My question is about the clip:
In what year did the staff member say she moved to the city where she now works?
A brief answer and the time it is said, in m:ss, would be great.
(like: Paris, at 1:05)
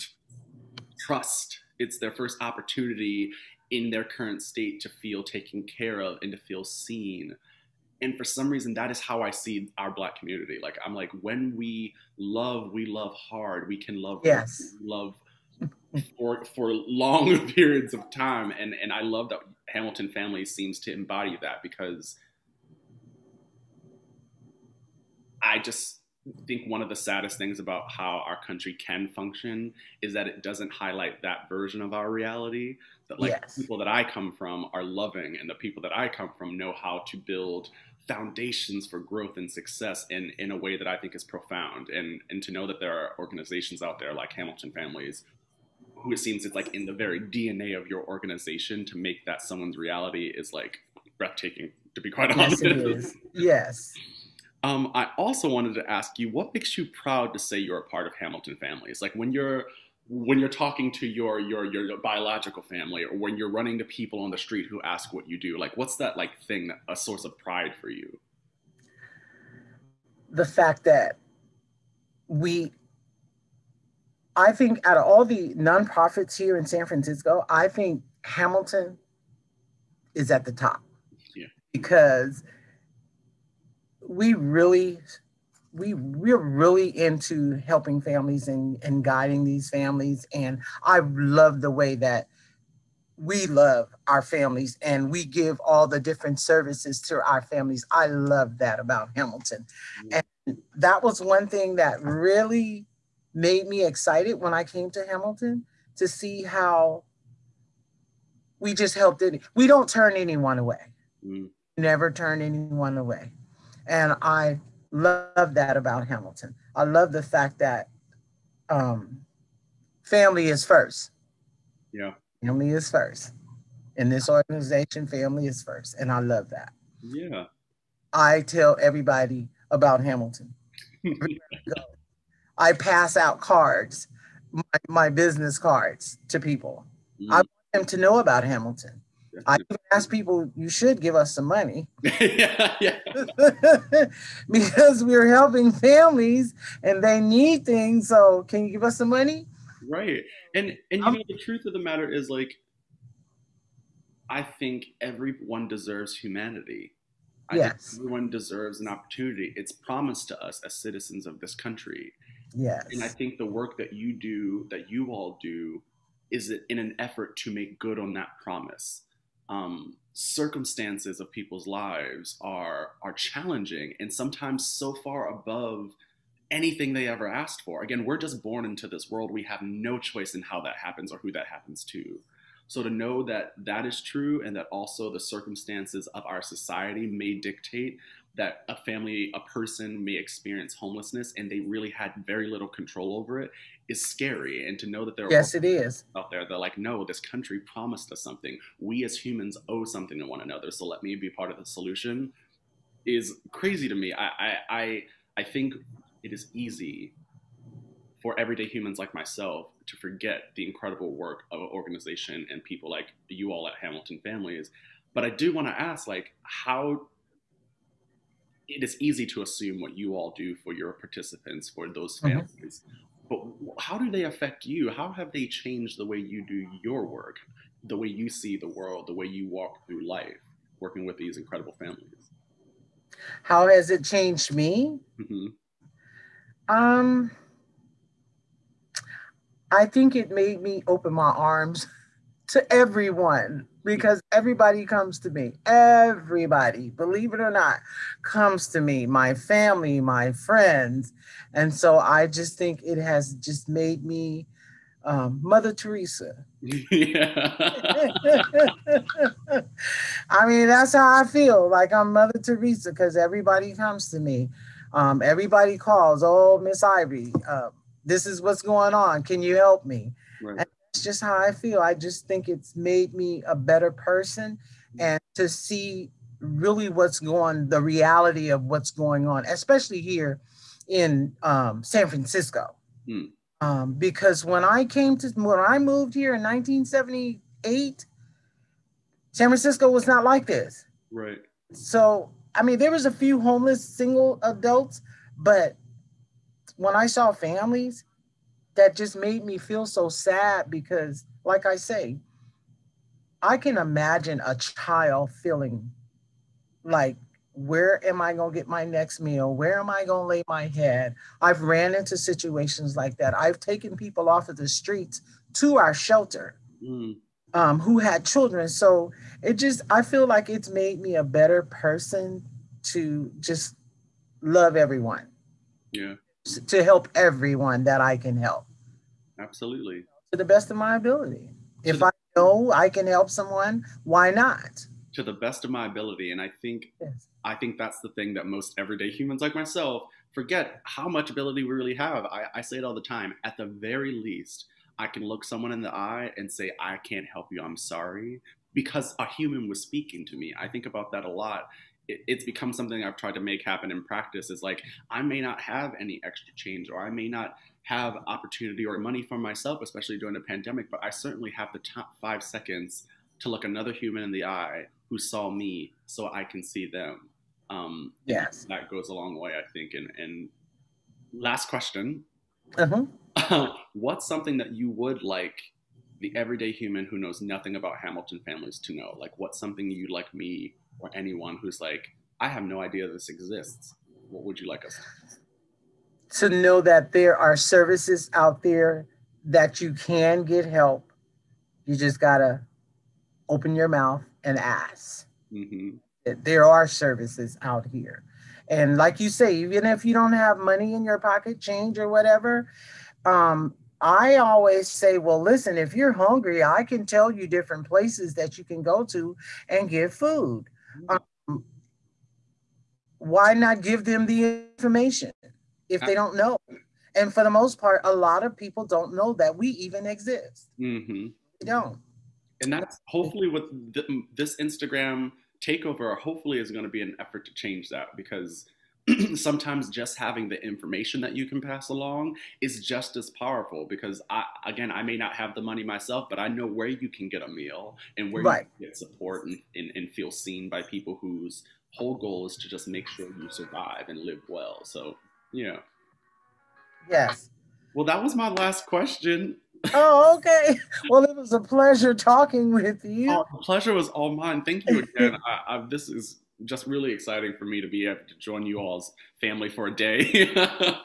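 1978, at 4:46.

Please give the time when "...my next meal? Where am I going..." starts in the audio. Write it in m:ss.
5:08.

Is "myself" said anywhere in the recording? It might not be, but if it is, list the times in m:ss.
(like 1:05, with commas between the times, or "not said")
3:29, 5:39, 5:59, 7:15.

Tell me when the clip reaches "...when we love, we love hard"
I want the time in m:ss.
0:11.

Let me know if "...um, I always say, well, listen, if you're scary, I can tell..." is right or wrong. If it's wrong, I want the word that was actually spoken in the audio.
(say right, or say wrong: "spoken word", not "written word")
wrong: "hungry", not "scary".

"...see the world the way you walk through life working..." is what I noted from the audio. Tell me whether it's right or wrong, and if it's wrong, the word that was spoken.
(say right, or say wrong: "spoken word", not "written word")
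right.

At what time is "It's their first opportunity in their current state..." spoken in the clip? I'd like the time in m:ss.
0:01.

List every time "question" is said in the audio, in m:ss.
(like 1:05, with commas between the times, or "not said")
6:11, 7:28.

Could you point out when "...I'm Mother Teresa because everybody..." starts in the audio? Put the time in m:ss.
4:21.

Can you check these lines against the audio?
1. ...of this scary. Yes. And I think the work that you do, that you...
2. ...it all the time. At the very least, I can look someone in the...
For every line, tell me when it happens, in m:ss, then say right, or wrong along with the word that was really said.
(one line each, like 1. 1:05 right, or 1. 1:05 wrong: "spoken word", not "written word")
1. 2:41 wrong: "country", not "scary"
2. 5:42 right.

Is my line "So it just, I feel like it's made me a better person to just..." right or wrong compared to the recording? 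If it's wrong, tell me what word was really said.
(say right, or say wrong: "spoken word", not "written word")
right.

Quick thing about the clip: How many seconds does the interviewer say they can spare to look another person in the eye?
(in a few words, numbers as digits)
5.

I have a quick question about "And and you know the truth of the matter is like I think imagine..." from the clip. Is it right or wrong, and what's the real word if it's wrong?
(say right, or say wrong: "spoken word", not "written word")
wrong: "everyone", not "imagine".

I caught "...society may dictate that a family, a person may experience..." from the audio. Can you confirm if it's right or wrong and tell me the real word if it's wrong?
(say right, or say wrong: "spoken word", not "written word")
right.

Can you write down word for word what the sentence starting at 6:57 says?
And for the most part, a lot of people don't know that we even exist.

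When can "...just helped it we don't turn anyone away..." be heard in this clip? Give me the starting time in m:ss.
1:48.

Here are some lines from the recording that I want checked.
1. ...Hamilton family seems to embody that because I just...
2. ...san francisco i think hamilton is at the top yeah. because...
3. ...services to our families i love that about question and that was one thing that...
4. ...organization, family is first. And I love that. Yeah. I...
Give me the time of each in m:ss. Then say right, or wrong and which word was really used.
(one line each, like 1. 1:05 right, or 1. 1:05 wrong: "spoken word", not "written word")
1. 0:19 right
2. 1:16 right
3. 1:36 wrong: "hamilton", not "question"
4. 2:04 right.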